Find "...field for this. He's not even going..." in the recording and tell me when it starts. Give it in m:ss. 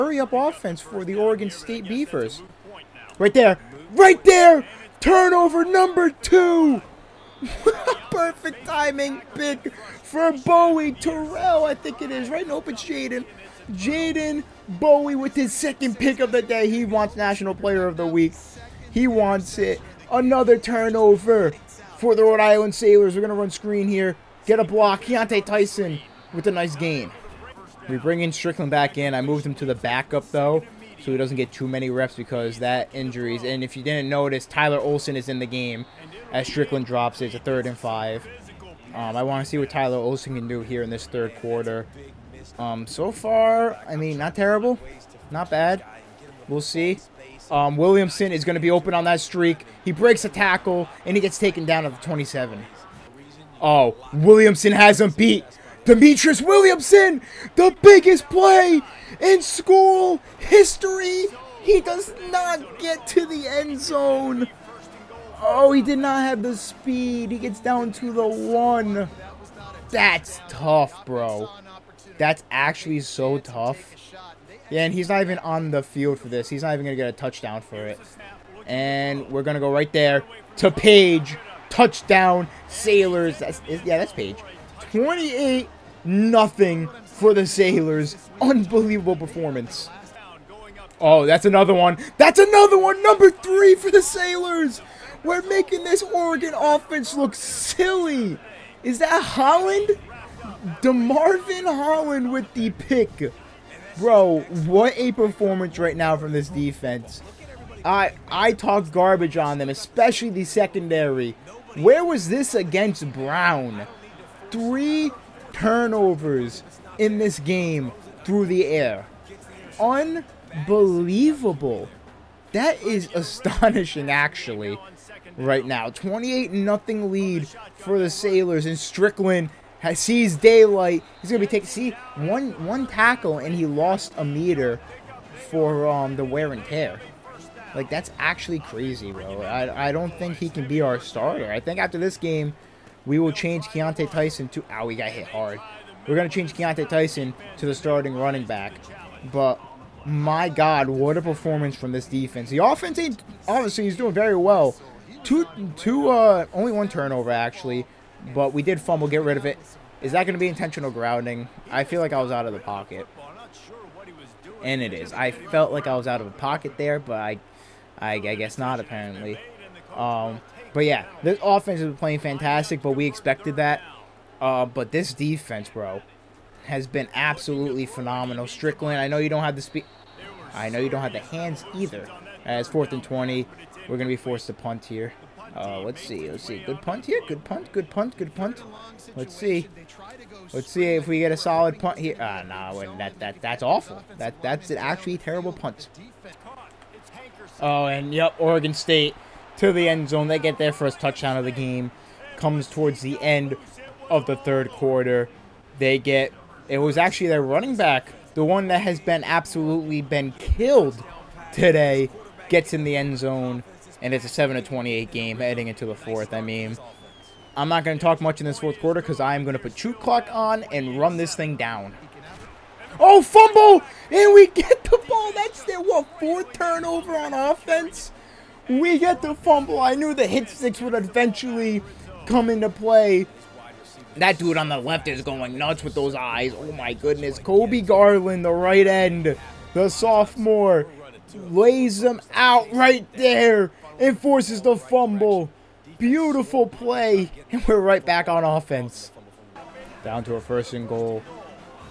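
1:15.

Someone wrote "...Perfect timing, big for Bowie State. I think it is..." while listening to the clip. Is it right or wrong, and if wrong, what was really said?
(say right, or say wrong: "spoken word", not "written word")
wrong: "Terrell", not "State".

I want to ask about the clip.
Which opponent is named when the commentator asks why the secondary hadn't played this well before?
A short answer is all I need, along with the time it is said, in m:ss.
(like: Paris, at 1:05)
Brown, at 1:53.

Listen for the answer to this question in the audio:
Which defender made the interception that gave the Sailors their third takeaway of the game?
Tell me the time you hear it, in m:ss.
1:40.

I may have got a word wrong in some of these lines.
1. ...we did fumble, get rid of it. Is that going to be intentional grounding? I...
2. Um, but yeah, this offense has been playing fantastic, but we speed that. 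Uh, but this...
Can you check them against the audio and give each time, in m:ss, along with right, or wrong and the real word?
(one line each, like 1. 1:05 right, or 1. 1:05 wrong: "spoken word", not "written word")
1. 2:38 right
2. 2:49 wrong: "expected", not "speed".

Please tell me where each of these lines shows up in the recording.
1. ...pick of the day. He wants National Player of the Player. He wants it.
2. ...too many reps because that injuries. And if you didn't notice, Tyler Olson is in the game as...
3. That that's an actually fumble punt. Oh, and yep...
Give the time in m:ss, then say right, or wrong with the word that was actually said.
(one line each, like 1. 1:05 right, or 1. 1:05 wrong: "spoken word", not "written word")
1. 0:15 wrong: "Week", not "Player"
2. 0:31 right
3. 3:14 wrong: "terrible", not "fumble".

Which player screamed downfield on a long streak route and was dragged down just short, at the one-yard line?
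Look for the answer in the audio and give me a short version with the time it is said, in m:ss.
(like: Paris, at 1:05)
Demetrius Williamson, at 0:55.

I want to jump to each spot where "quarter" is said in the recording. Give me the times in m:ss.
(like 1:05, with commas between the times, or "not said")
0:41, 3:24, 3:38.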